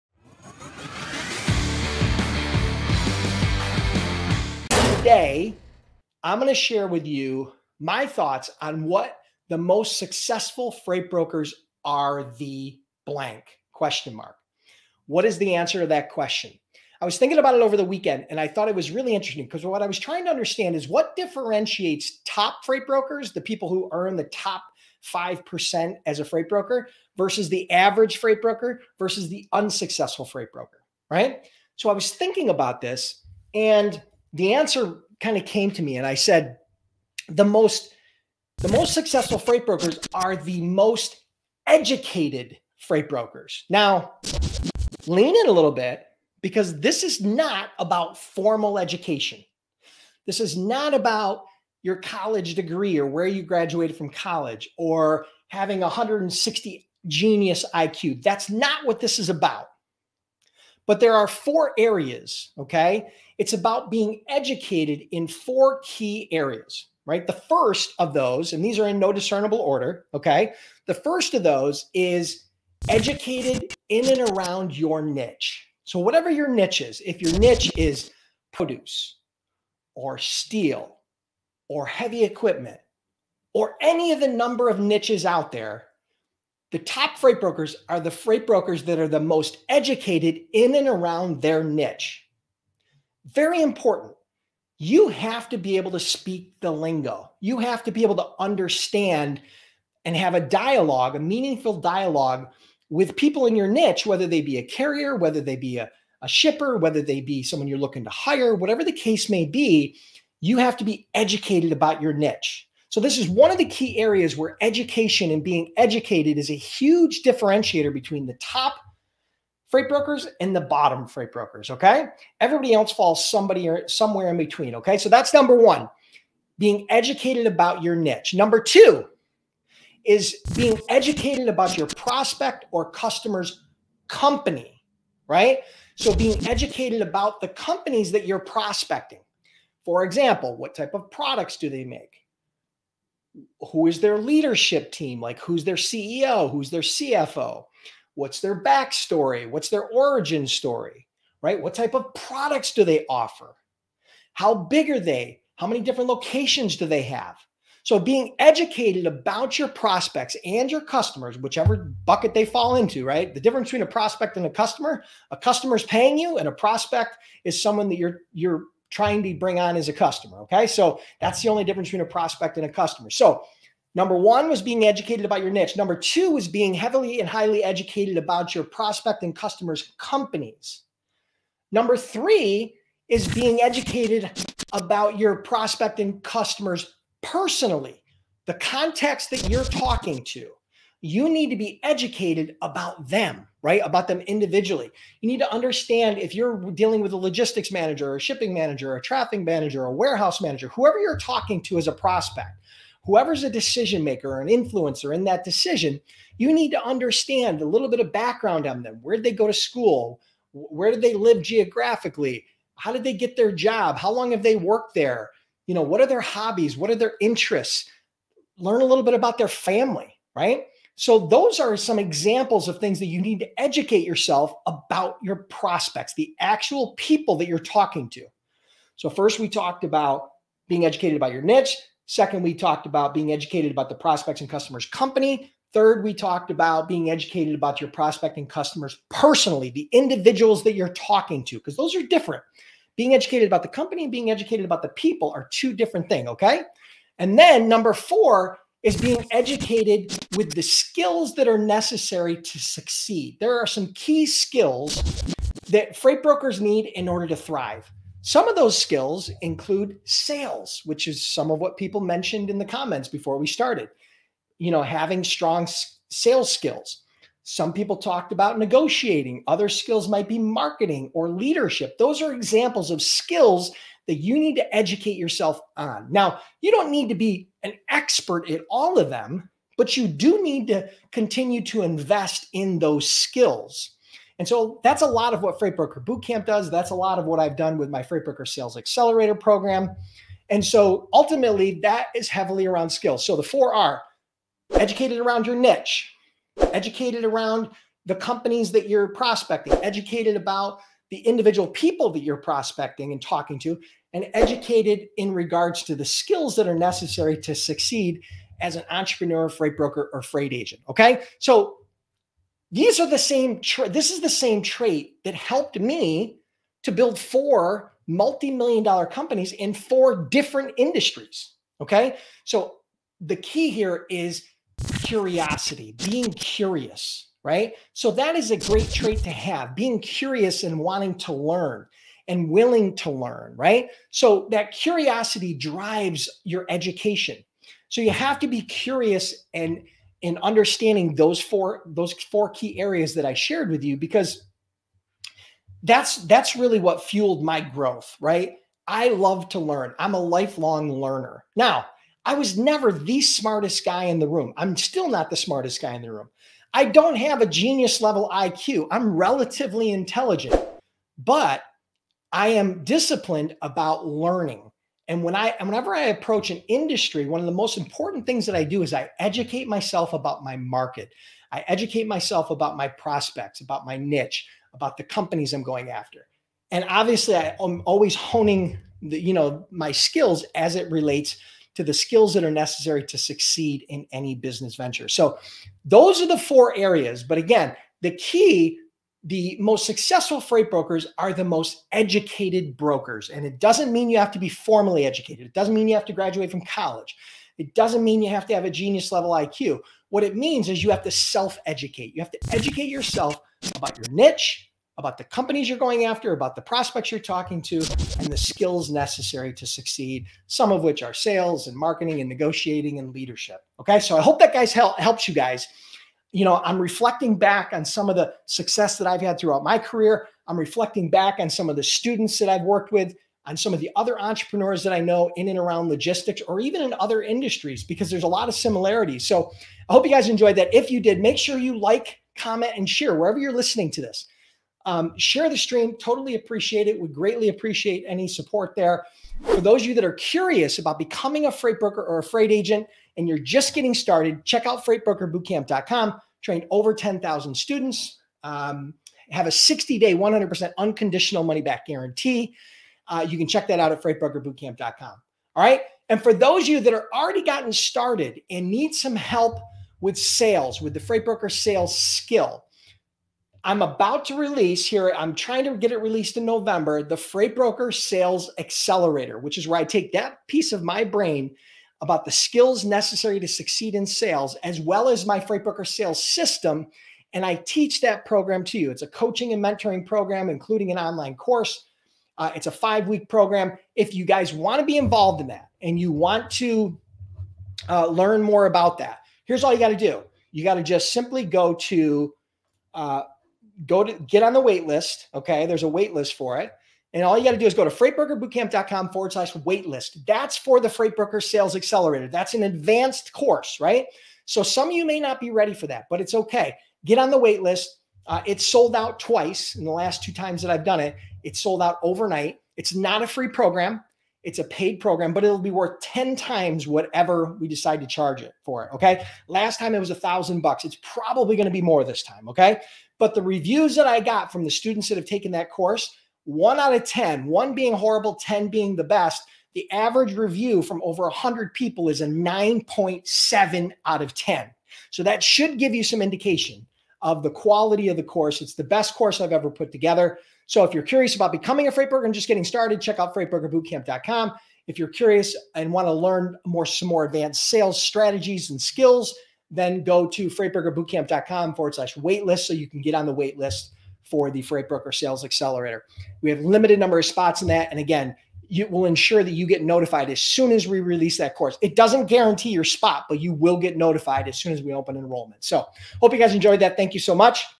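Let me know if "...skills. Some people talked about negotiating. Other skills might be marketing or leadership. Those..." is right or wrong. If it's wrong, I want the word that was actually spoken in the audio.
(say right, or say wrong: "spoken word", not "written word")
right.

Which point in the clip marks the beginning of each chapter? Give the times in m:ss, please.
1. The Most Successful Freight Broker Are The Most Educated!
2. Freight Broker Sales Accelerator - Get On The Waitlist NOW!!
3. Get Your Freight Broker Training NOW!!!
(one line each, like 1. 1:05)
1. 0:37
2. 7:36
3. 7:19.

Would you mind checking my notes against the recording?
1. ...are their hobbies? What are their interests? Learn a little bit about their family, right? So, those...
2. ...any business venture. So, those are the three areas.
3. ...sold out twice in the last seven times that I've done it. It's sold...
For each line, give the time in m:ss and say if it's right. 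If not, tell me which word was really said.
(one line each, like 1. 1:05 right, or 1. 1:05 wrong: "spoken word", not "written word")
1. 3:36 right
2. 6:24 wrong: "four", not "three"
3. 8:28 wrong: "two", not "seven".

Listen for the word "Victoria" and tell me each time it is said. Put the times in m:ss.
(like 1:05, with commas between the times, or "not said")
not said.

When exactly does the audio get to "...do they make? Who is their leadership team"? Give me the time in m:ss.
2:21.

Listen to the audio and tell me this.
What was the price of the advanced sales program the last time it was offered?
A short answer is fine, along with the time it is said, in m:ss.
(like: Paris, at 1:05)
$1,000, at 8:40.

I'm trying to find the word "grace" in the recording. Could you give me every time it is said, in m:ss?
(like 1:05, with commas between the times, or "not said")
not said.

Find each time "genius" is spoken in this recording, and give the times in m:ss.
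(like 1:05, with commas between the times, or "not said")
0:57, 5:57, 6:38.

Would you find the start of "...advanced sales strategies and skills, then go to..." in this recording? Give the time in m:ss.
9:07.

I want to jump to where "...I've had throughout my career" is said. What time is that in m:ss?
6:59.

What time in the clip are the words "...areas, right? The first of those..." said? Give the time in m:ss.
1:06.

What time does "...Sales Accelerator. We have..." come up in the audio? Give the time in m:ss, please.
9:15.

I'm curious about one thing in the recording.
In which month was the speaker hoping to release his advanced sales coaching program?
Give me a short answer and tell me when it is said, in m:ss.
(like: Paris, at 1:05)
November, at 7:46.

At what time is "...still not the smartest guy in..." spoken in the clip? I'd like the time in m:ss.
5:54.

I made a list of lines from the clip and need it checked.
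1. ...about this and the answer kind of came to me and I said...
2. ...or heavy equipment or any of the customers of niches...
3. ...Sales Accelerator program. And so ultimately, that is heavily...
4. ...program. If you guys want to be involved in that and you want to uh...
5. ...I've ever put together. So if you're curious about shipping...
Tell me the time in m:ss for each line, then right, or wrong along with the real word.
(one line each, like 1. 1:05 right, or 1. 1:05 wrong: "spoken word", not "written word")
1. 0:32 right
2. 1:21 wrong: "number", not "customers"
3. 4:48 right
4. 8:03 right
5. 8:59 wrong: "becoming", not "shipping".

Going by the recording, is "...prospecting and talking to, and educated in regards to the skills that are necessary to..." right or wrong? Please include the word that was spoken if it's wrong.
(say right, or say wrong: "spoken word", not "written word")
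right.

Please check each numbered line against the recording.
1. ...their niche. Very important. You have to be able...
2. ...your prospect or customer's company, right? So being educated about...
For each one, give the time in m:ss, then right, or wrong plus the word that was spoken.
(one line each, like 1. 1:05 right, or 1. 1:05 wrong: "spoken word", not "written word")
1. 1:31 right
2. 2:11 right.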